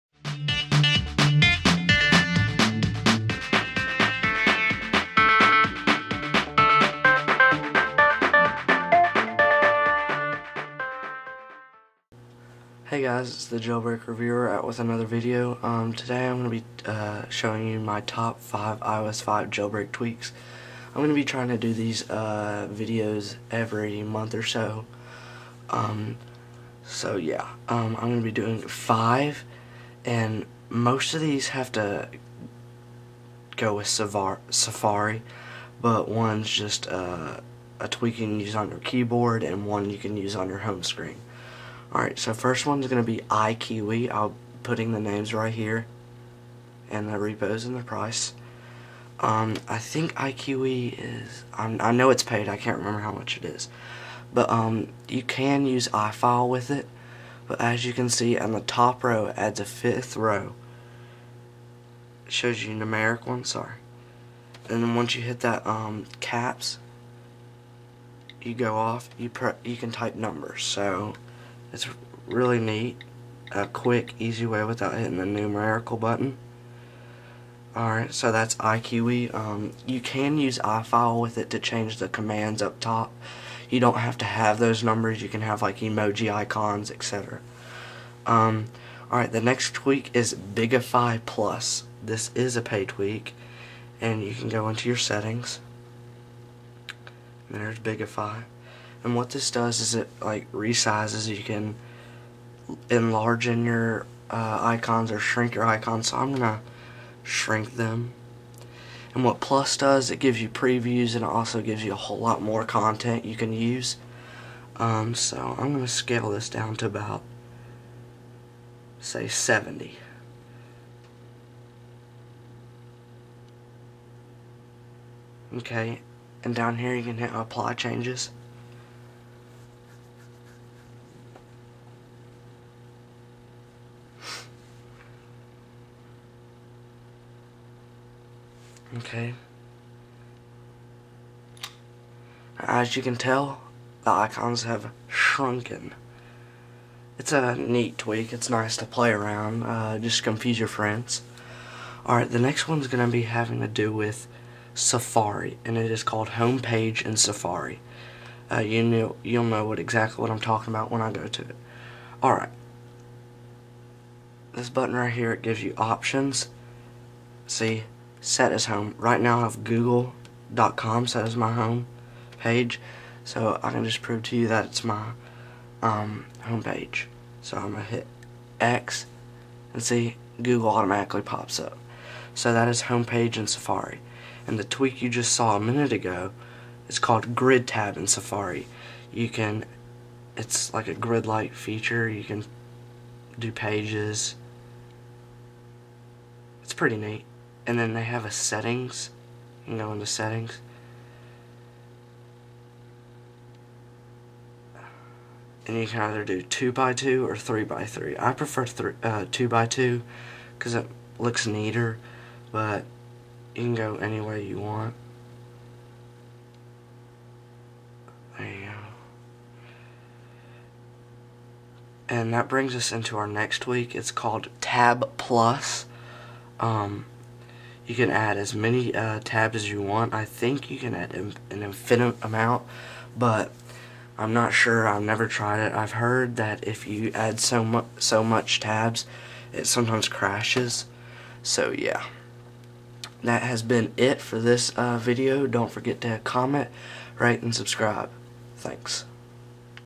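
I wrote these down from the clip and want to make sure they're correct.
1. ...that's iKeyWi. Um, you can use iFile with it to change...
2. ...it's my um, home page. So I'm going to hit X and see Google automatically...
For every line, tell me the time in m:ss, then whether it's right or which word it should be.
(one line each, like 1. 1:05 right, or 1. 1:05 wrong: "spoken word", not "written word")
1. 1:18 right
2. 2:54 right.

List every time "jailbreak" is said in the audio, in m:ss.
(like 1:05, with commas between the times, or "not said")
0:13, 0:19.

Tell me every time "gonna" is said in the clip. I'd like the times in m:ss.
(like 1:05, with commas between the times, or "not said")
1:46, 1:55.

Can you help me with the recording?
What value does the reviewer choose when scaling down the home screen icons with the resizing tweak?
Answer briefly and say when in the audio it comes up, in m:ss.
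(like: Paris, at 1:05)
70, at 1:59.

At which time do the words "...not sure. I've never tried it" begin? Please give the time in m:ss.
3:54.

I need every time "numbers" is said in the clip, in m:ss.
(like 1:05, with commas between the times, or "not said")
1:10, 1:24.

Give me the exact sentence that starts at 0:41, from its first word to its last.
Alright, so first one's going to be iKeyWi.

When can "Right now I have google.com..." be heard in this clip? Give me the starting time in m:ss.
2:48.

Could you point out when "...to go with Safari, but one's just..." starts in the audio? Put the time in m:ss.
0:31.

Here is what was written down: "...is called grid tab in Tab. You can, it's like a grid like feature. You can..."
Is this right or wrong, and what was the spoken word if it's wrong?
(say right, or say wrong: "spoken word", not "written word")
wrong: "Safari", not "Tab".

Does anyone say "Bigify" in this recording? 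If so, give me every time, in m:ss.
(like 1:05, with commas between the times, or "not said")
1:30, 1:37.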